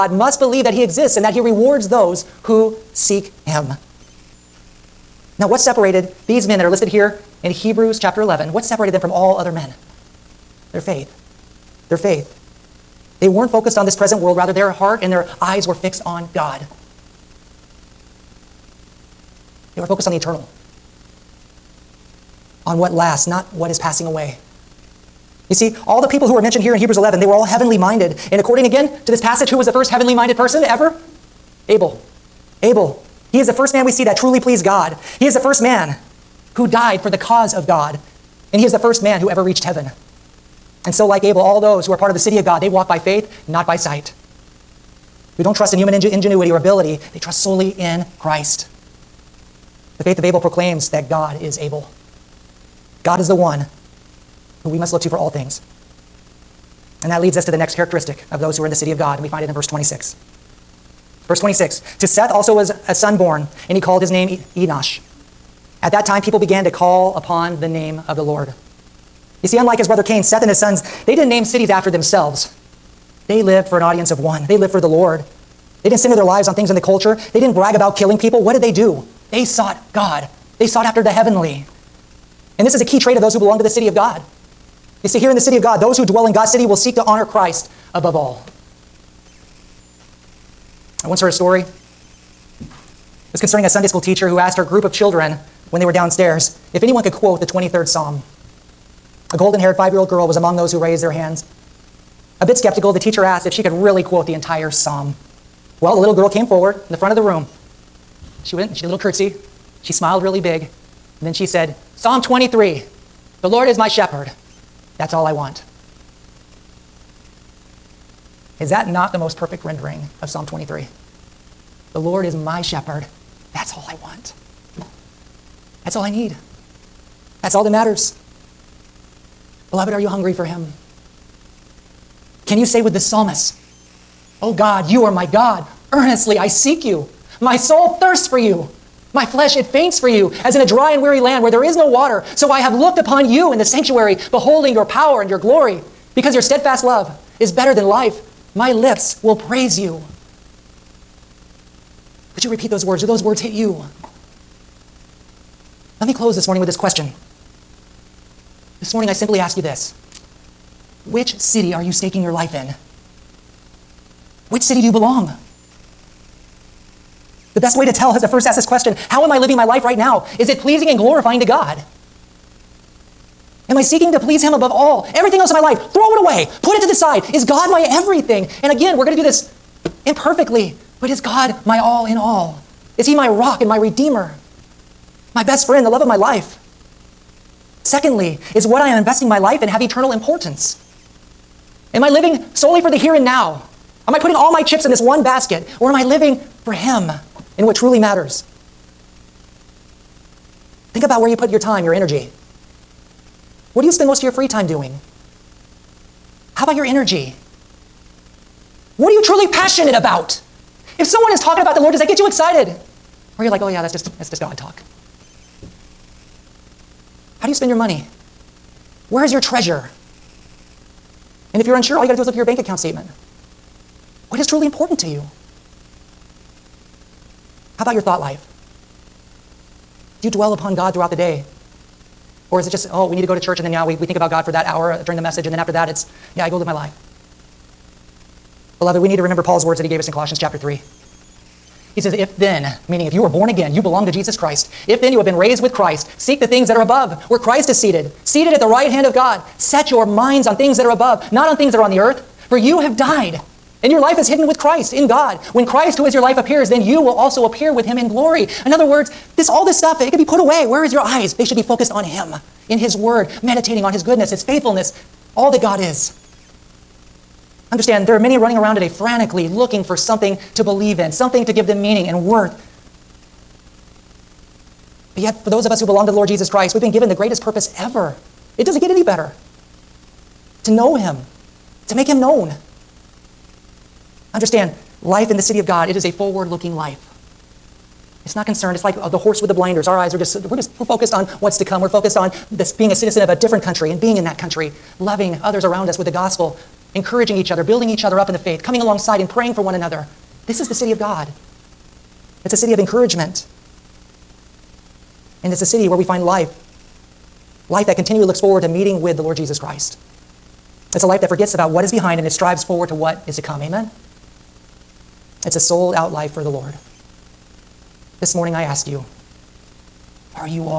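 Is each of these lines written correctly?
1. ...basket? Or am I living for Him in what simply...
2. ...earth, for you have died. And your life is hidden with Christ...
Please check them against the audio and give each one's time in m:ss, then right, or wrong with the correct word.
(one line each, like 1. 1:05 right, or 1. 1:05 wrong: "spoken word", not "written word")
1. 3:15 wrong: "truly", not "simply"
2. 4:11 right.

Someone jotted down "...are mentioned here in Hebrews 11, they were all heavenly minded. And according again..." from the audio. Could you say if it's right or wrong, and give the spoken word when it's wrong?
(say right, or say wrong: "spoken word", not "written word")
right.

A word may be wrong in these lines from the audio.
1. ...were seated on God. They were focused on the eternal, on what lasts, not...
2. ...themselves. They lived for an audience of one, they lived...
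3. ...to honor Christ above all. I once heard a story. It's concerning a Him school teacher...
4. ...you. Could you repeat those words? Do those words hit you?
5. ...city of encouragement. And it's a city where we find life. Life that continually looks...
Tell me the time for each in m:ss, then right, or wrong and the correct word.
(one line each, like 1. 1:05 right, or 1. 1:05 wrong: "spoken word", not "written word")
1. 0:15 wrong: "fixed", not "seated"
2. 1:11 right
3. 1:26 wrong: "Sunday", not "Him"
4. 2:29 right
5. 5:02 right.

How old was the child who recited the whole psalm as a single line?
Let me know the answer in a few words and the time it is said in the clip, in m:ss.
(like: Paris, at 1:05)
5, at 1:39.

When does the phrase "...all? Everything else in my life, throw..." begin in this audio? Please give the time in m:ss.
2:54.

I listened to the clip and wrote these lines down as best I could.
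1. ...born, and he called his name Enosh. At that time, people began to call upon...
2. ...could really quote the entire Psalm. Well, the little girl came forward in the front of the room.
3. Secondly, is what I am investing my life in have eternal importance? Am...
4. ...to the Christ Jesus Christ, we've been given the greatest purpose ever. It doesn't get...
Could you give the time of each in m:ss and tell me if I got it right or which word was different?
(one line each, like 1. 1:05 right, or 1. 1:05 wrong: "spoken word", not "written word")
1. 1:03 right
2. 1:43 right
3. 3:07 right
4. 4:36 wrong: "Lord", not "Christ".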